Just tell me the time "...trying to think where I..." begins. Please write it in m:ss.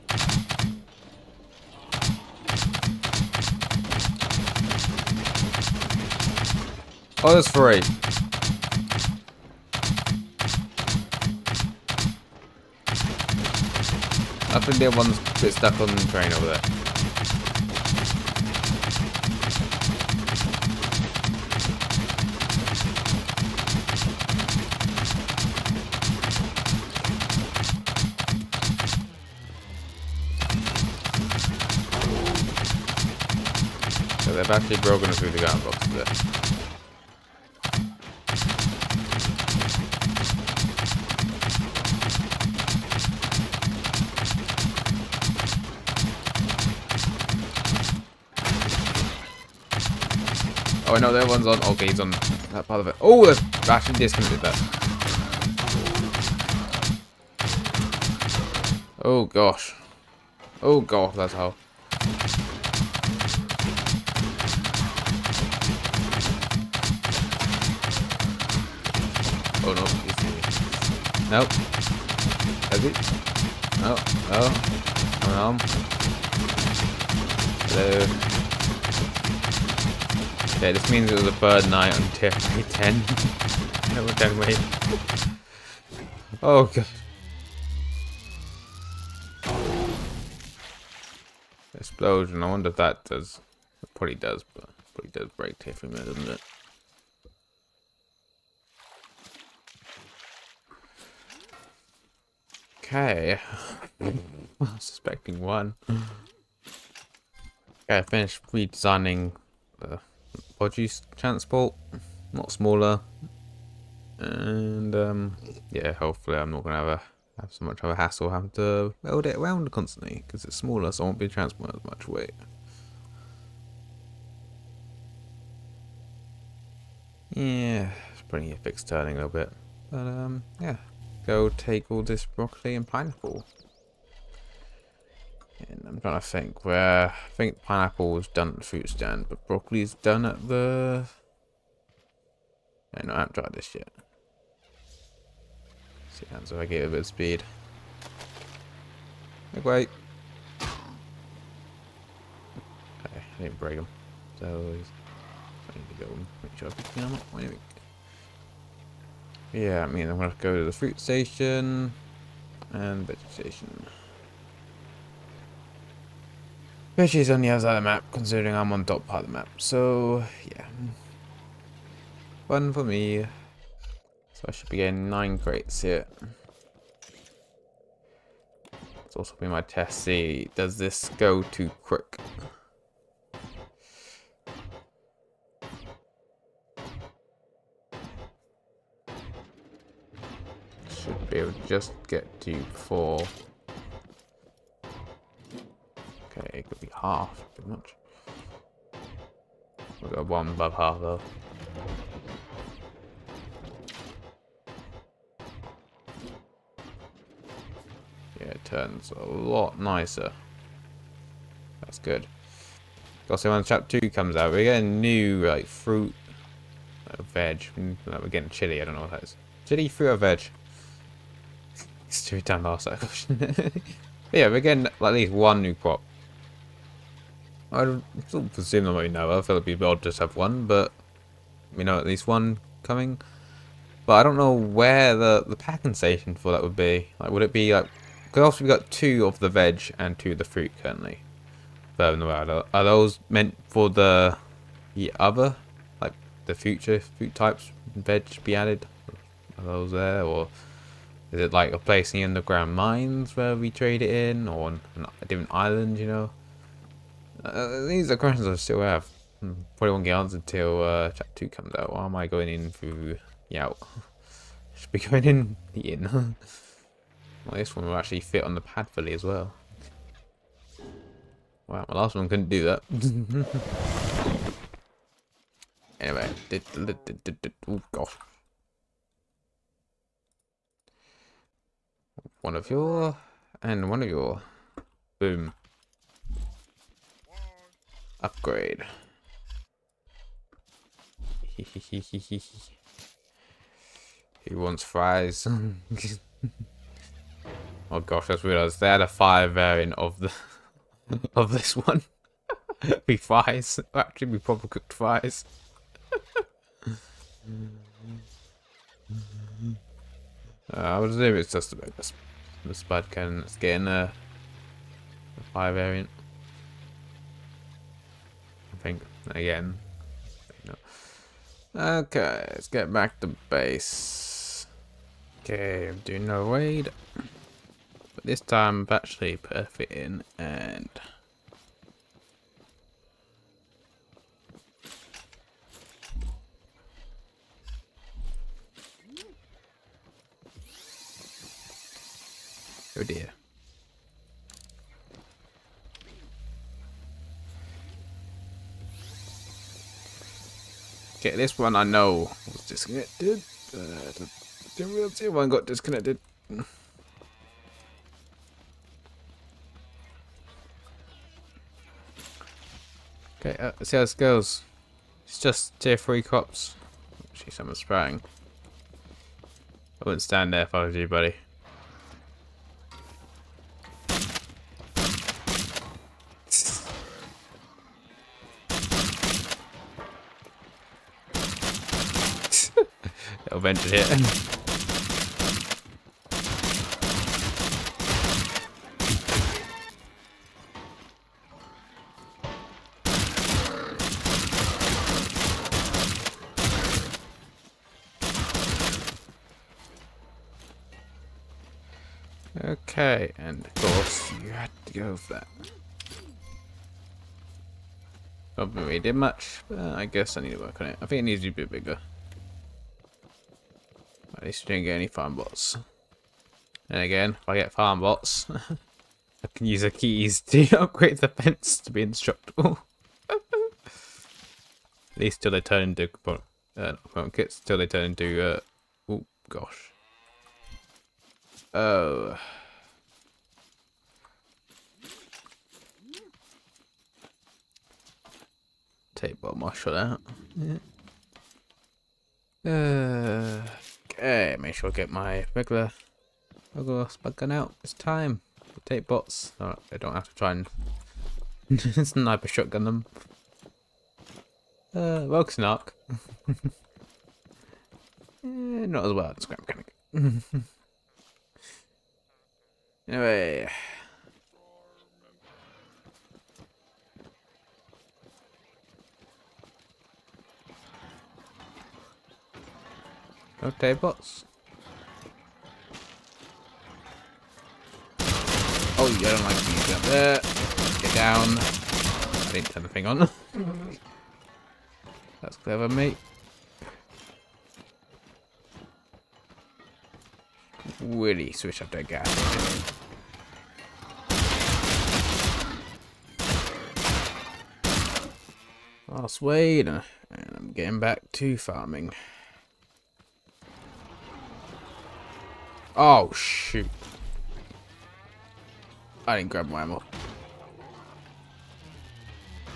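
2:16.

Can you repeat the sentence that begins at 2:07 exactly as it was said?
Yeah, it's bringing a fixed turning a little bit.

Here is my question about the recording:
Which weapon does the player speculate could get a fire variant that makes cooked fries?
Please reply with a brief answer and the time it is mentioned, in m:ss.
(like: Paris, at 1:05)
Spud cannon, at 5:12.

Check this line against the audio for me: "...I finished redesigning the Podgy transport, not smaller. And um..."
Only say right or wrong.
right.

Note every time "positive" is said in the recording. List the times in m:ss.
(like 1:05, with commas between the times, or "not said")
not said.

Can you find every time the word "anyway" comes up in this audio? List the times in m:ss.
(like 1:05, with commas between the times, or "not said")
4:36, 7:43.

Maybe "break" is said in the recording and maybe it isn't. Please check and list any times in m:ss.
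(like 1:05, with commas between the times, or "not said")
1:35, 2:33.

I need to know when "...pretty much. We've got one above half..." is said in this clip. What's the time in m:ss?
3:17.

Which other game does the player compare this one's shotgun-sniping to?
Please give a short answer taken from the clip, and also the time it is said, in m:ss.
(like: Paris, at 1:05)
Scrap Mechanic, at 7:39.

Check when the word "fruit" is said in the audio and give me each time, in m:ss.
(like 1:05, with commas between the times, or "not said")
2:18, 2:40, 3:35, 3:39, 4:00, 4:07.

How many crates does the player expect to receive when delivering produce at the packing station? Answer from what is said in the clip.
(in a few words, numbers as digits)
9.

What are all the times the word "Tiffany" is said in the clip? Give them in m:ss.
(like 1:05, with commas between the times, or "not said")
1:22, 1:35.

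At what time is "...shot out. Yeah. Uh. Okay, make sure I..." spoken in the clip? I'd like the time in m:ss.
7:19.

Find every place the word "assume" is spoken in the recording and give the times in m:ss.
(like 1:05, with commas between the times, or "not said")
3:48, 5:11.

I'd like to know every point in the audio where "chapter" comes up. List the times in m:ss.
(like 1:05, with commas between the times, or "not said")
3:33, 4:21.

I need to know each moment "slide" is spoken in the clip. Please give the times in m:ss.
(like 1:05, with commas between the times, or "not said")
not said.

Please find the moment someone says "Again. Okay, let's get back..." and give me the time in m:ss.
5:19.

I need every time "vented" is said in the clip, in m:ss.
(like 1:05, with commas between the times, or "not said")
6:23.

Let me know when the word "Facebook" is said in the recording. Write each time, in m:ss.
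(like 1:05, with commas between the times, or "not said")
not said.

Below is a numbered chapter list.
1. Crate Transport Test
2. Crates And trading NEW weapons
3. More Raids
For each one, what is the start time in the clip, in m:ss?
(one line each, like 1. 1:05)
1. 1:47
2. 2:53
3. 5:24.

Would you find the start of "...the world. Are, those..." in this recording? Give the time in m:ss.
4:02.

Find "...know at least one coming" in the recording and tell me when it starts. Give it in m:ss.
3:51.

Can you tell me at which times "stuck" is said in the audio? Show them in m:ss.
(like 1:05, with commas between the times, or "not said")
0:15.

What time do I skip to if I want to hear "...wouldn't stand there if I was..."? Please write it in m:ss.
6:10.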